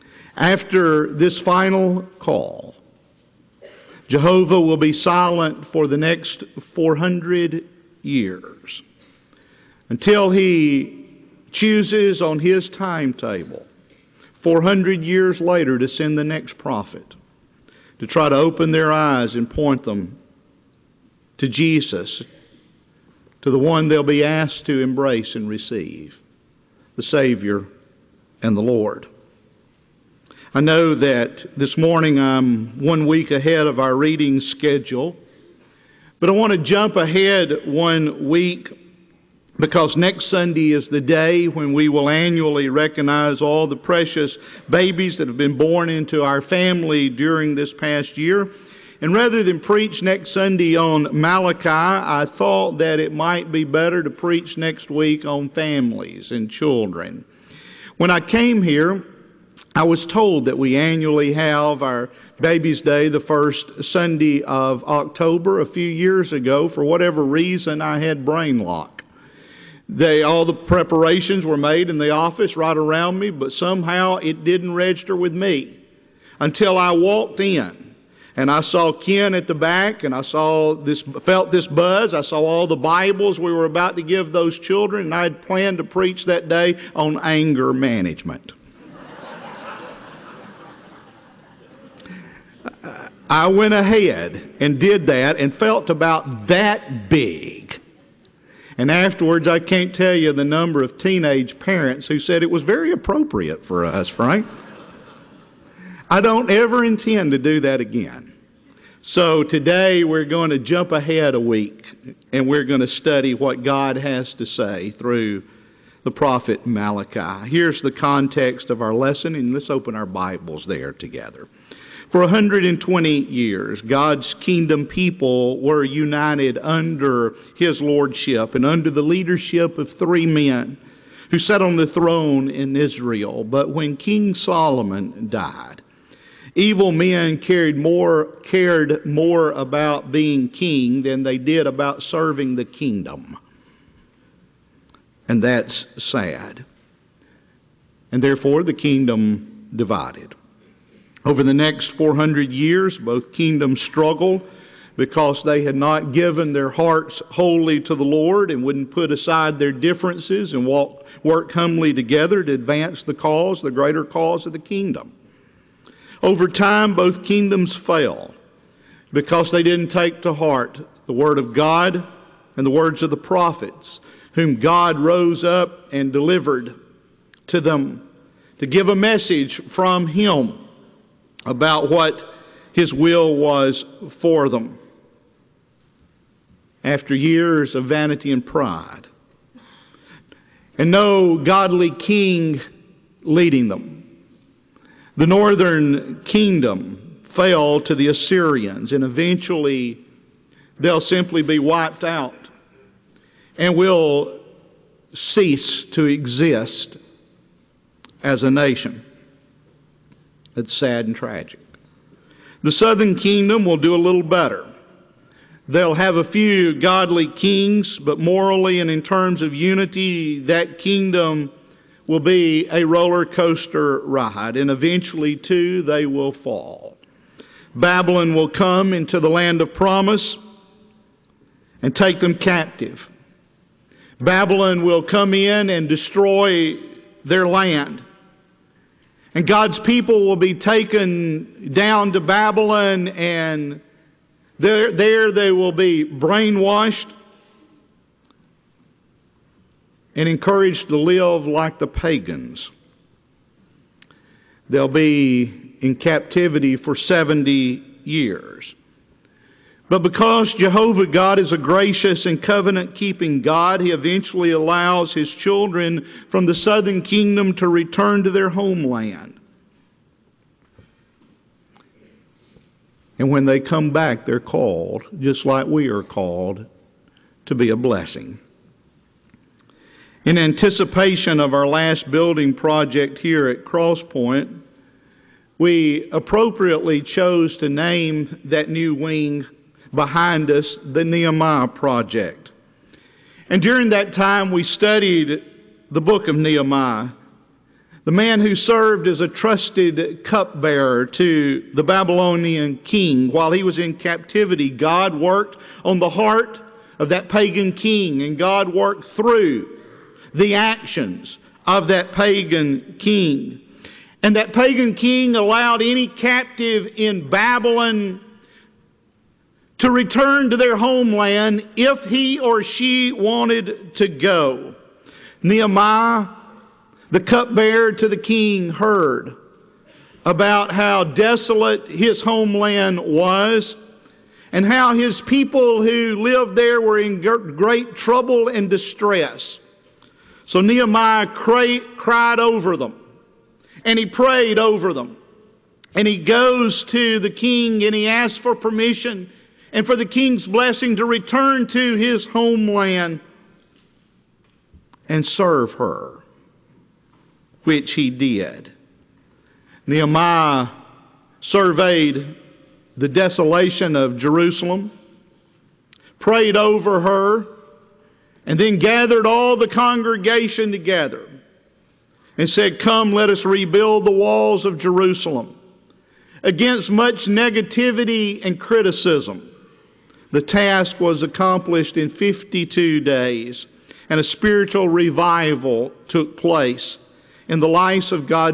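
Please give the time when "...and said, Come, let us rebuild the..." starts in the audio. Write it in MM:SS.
06:12.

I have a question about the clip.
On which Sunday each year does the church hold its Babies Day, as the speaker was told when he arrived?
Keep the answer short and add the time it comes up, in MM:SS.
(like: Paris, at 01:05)
The first Sunday of October, at 01:03.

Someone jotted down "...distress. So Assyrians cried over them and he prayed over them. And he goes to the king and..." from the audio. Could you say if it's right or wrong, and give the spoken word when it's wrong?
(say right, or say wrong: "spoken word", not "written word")
wrong: "Nehemiah", not "Assyrians".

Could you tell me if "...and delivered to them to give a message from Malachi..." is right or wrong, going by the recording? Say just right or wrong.
wrong.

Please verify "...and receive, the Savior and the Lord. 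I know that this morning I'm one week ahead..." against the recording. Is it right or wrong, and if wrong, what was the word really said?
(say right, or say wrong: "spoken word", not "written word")
right.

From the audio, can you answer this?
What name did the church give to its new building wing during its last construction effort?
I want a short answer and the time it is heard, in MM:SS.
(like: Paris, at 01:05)
The Nehemiah Project, at 04:50.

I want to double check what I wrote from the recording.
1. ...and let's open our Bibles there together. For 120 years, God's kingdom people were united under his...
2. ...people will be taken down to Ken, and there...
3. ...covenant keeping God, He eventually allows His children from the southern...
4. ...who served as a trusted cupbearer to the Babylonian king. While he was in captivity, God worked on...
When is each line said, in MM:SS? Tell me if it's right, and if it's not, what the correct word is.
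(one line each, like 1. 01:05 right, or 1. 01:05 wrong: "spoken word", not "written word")
1. 01:59 right
2. 03:59 wrong: "Babylon", not "Ken"
3. 04:22 right
4. 04:58 right.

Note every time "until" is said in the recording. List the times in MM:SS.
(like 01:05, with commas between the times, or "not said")
00:09, 01:16.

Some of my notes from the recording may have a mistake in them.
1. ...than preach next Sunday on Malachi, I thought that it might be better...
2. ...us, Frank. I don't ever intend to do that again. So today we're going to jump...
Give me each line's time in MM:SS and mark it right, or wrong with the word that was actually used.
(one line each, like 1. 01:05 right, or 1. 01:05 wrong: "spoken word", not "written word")
1. 00:49 right
2. 01:43 right.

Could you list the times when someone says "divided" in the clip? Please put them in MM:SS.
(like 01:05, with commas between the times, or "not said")
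02:29.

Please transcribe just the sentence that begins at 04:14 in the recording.
They'll be in captivity for 70 years.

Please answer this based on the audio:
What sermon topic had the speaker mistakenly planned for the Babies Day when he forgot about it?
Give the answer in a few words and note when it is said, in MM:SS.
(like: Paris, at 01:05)
Anger management, at 01:27.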